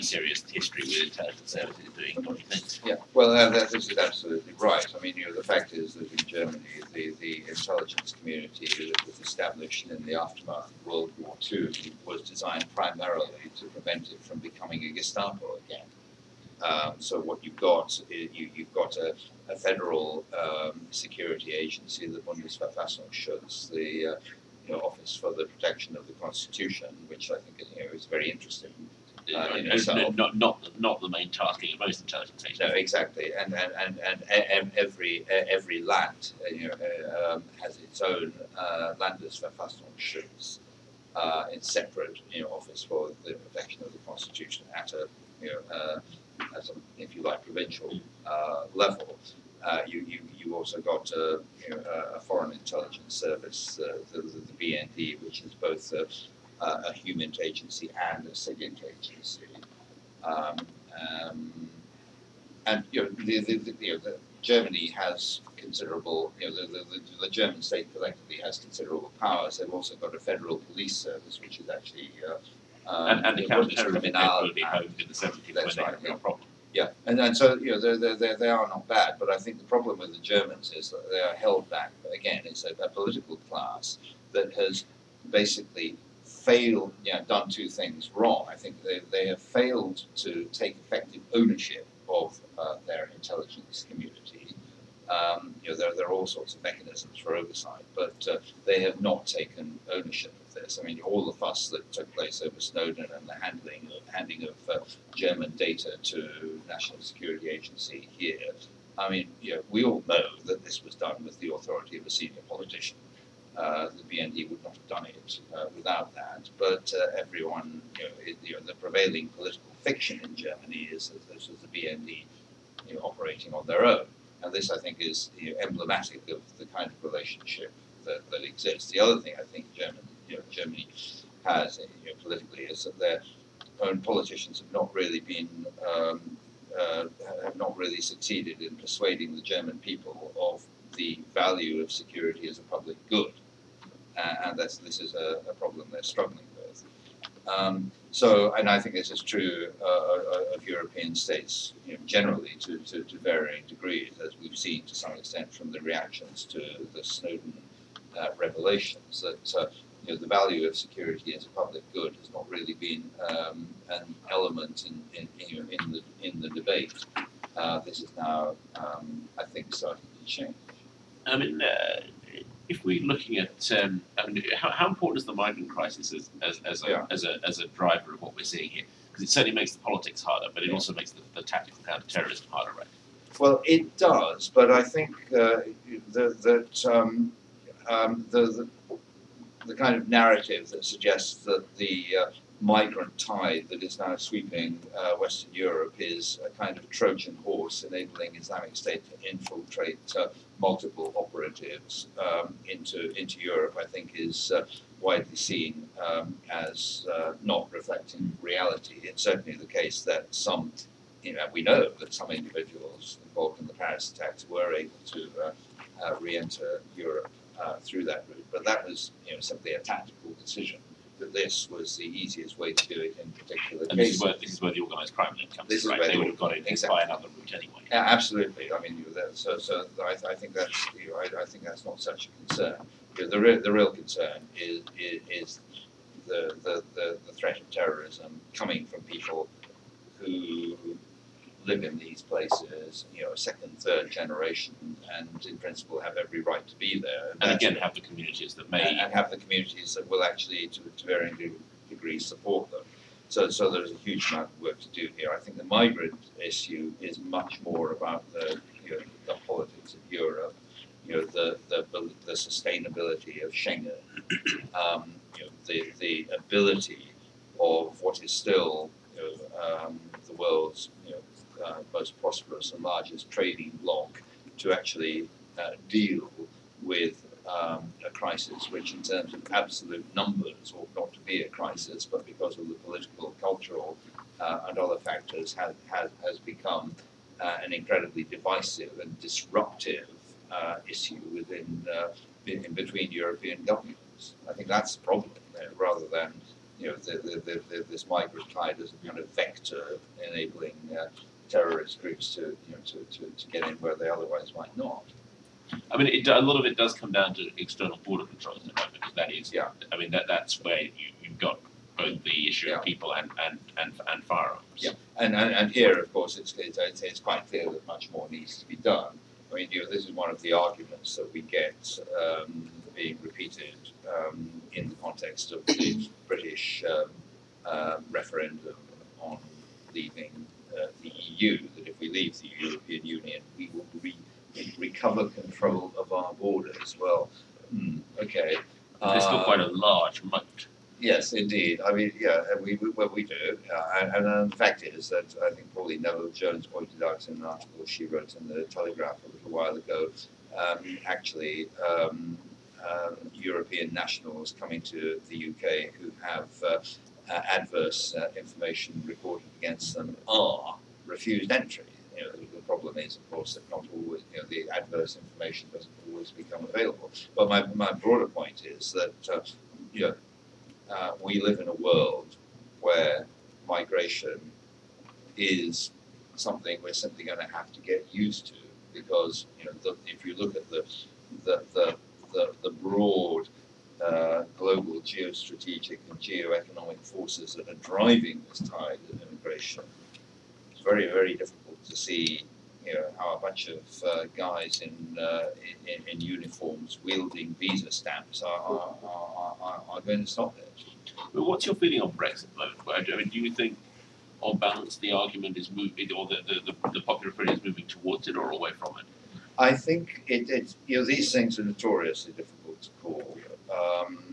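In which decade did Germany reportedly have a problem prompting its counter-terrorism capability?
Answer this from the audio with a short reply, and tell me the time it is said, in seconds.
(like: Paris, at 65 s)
the 70s, at 75 s.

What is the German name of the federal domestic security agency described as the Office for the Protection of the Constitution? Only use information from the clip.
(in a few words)
Bundesverfassungsschutz.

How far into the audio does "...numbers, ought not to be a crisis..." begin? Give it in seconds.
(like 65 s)
280 s.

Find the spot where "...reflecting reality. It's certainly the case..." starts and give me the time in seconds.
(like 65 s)
207 s.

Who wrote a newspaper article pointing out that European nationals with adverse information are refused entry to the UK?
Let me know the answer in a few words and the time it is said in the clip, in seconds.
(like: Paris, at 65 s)
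Pauline Neville Jones, at 345 s.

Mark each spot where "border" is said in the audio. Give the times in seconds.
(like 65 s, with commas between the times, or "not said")
308 s, 336 s.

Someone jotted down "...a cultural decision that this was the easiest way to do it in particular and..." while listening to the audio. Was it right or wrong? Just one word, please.
wrong.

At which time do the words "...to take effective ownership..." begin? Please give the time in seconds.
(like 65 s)
90 s.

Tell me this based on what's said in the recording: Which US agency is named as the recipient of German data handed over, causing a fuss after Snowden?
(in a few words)
National Security Agency.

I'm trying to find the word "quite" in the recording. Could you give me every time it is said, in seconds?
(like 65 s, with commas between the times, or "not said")
317 s, 339 s.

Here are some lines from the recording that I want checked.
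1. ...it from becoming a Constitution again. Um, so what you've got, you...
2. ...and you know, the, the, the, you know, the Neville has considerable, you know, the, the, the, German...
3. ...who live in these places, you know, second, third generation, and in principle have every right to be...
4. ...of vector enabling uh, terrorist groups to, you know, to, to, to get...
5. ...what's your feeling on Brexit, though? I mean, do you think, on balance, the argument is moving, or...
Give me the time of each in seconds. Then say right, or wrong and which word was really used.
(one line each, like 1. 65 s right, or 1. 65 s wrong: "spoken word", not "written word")
1. 14 s wrong: "Gestapo", not "Constitution"
2. 62 s wrong: "Germany", not "Neville"
3. 240 s right
4. 299 s right
5. 401 s right.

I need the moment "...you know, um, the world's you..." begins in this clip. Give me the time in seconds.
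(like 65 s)
269 s.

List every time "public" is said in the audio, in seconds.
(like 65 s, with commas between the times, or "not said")
142 s, 161 s.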